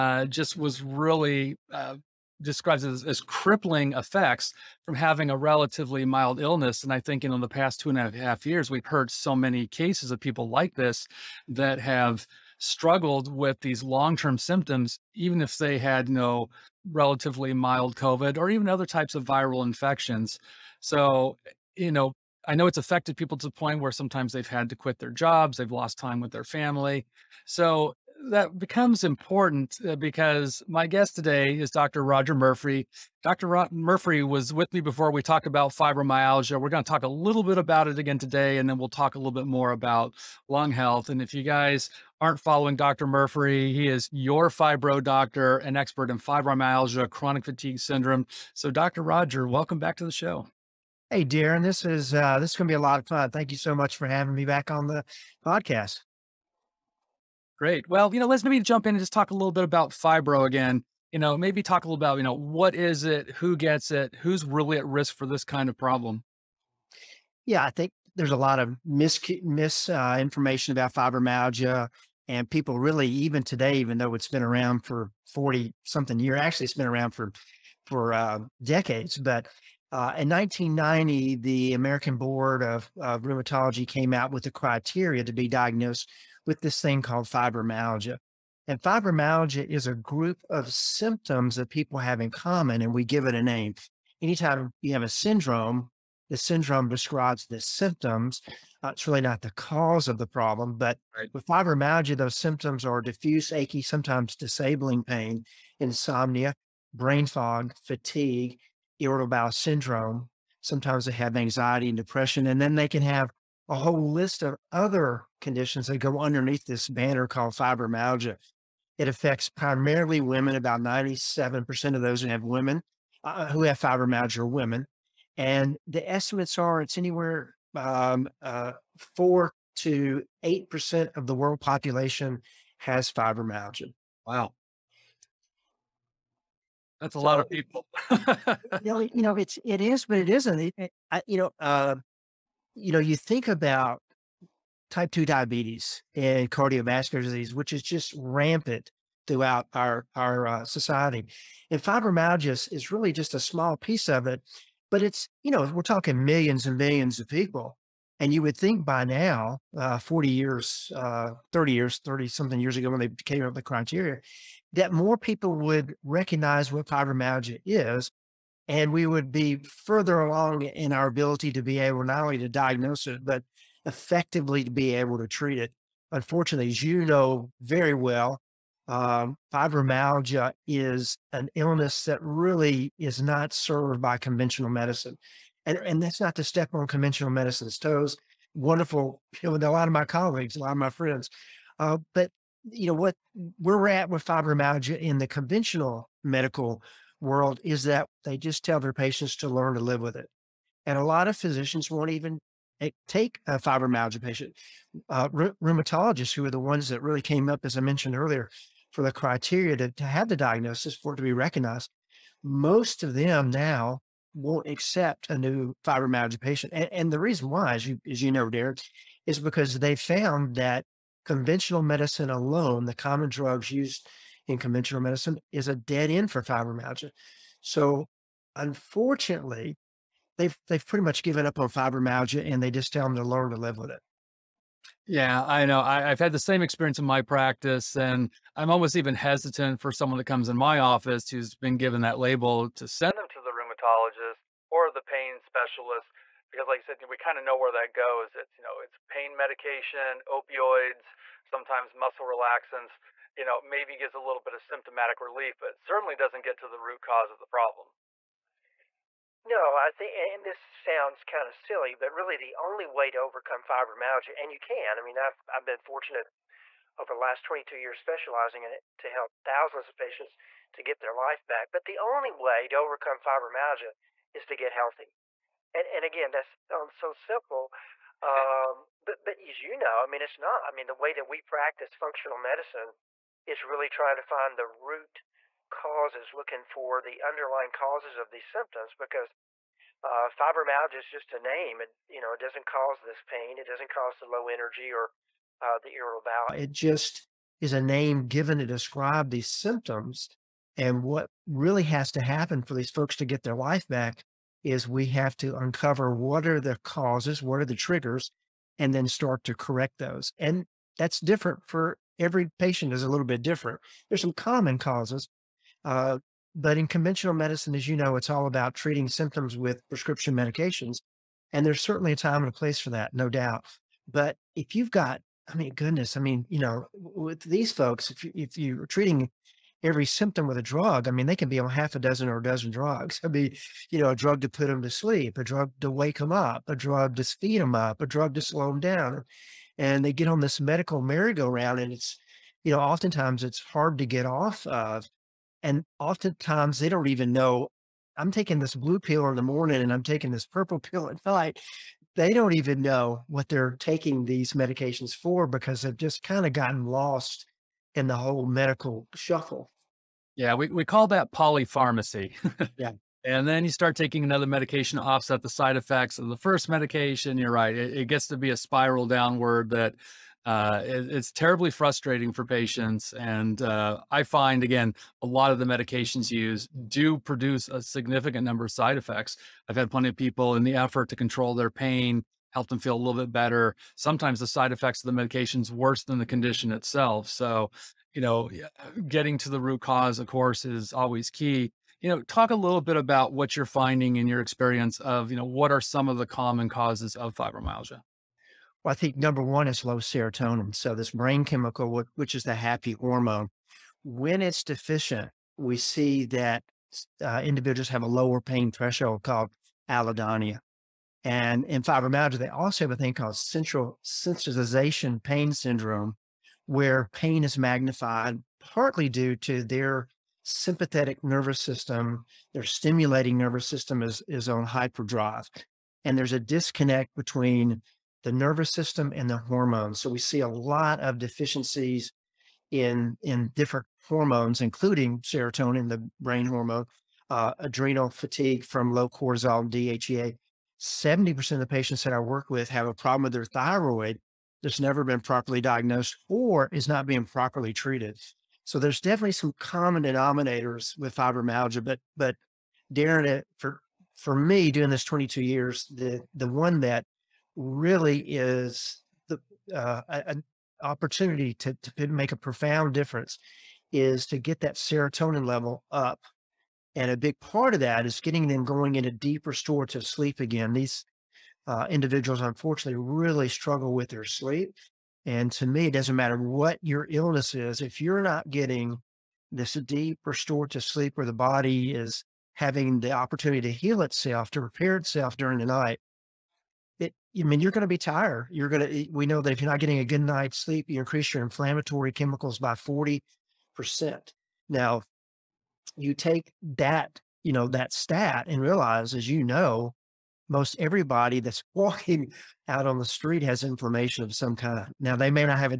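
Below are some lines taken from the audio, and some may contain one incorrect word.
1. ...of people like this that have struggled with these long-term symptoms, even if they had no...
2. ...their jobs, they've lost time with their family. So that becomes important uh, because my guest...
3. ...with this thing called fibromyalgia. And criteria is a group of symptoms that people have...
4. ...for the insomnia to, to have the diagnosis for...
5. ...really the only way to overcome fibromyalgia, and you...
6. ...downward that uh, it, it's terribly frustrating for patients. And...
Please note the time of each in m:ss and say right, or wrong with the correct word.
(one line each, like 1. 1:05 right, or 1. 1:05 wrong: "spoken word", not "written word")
1. 0:10 right
2. 0:24 right
3. 1:26 wrong: "fibromyalgia", not "criteria"
4. 3:28 wrong: "criteria", not "insomnia"
5. 4:22 right
6. 6:09 right.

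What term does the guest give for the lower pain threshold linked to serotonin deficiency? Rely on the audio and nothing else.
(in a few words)
allodynia.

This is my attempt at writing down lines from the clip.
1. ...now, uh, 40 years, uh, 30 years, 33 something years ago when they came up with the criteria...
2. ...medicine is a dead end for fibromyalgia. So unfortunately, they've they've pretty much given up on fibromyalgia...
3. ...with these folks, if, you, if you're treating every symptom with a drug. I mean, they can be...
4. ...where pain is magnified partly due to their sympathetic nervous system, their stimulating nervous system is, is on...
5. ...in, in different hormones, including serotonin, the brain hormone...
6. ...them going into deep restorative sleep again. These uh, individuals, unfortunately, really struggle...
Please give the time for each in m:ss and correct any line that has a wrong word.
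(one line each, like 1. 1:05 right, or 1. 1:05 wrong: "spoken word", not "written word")
1. 2:39 wrong: "30", not "33"
2. 3:45 right
3. 5:26 right
4. 6:56 right
5. 7:12 right
6. 7:48 right.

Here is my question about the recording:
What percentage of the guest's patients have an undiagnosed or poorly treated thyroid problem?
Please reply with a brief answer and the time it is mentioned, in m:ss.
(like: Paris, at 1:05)
70%, at 7:20.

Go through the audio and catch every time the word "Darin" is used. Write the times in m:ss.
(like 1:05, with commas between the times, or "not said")
0:51, 7:32.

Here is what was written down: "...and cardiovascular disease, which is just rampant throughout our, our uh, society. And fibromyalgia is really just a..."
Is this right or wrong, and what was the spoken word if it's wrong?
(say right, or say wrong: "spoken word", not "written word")
right.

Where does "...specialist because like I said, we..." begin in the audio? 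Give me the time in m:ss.
4:05.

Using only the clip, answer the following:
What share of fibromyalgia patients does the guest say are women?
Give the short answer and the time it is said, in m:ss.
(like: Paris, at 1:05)
97%, at 2:00.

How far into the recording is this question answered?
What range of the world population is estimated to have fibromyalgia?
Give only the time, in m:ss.
2:09.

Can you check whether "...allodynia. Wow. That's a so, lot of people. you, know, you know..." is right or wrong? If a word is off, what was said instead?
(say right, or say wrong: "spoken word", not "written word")
wrong: "fibromyalgia", not "allodynia".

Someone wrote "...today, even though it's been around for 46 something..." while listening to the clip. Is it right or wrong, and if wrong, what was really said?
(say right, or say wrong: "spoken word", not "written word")
wrong: "40", not "46".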